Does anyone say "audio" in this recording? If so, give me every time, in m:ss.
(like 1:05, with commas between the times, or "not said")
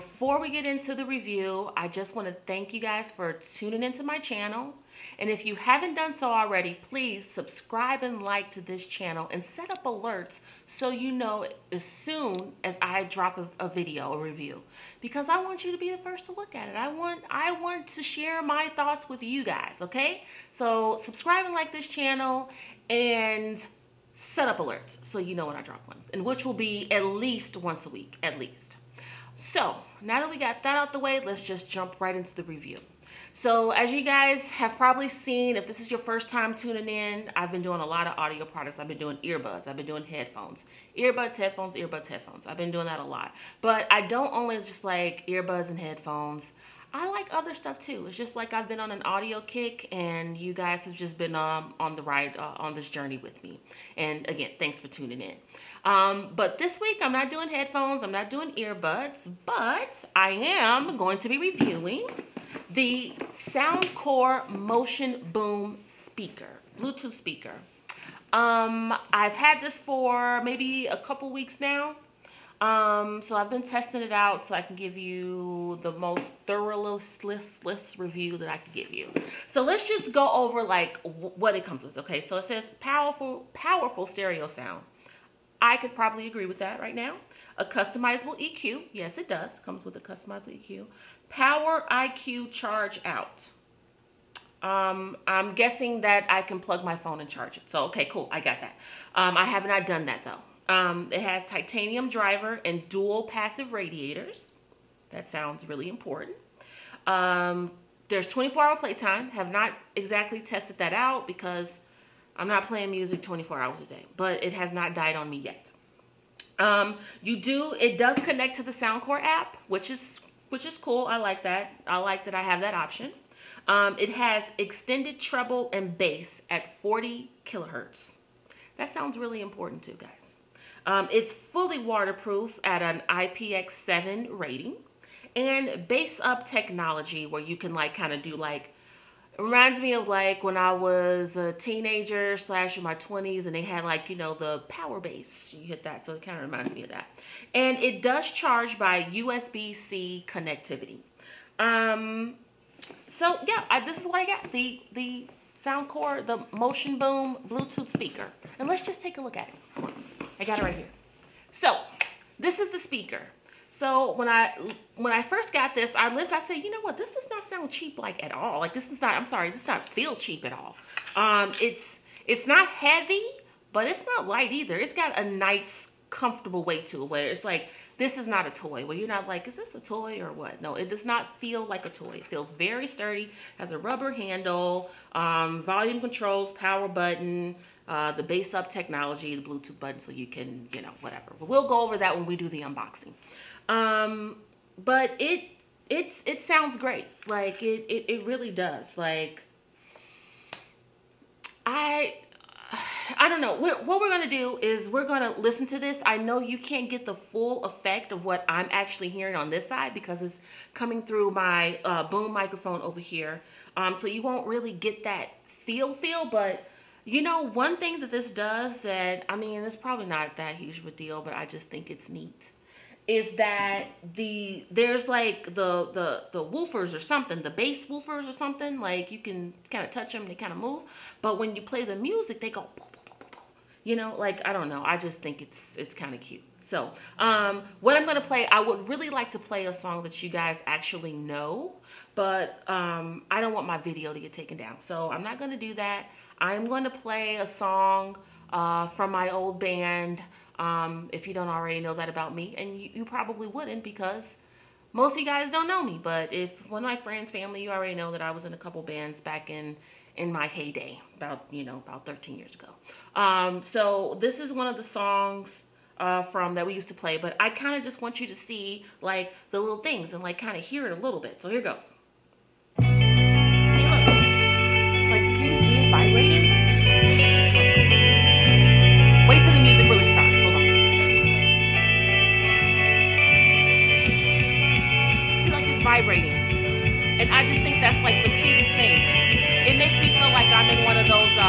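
0:38, 0:49.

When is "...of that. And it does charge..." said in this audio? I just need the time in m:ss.
2:26.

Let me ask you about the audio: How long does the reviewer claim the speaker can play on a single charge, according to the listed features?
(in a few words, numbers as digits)
24 hours.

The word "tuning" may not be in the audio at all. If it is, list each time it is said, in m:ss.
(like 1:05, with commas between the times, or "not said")
0:03, 0:36, 0:54.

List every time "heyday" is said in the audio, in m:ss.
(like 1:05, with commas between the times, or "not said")
4:20.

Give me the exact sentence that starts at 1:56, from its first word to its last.
Um, you do, it does connect to the Soundcore app, which is, which is cool.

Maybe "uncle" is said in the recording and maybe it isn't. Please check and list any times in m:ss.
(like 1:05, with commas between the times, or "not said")
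not said.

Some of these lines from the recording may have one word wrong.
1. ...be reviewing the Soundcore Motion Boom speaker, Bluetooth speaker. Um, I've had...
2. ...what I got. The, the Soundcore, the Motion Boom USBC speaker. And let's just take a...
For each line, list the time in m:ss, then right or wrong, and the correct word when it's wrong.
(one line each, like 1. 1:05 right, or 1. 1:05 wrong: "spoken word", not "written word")
1. 1:01 right
2. 2:34 wrong: "Bluetooth", not "USBC".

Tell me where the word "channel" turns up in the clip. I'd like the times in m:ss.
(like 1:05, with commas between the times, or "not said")
0:04, 0:08, 0:21.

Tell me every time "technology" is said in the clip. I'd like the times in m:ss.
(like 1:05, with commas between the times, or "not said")
2:16, 3:08.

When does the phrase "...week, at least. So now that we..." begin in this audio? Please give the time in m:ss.
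0:27.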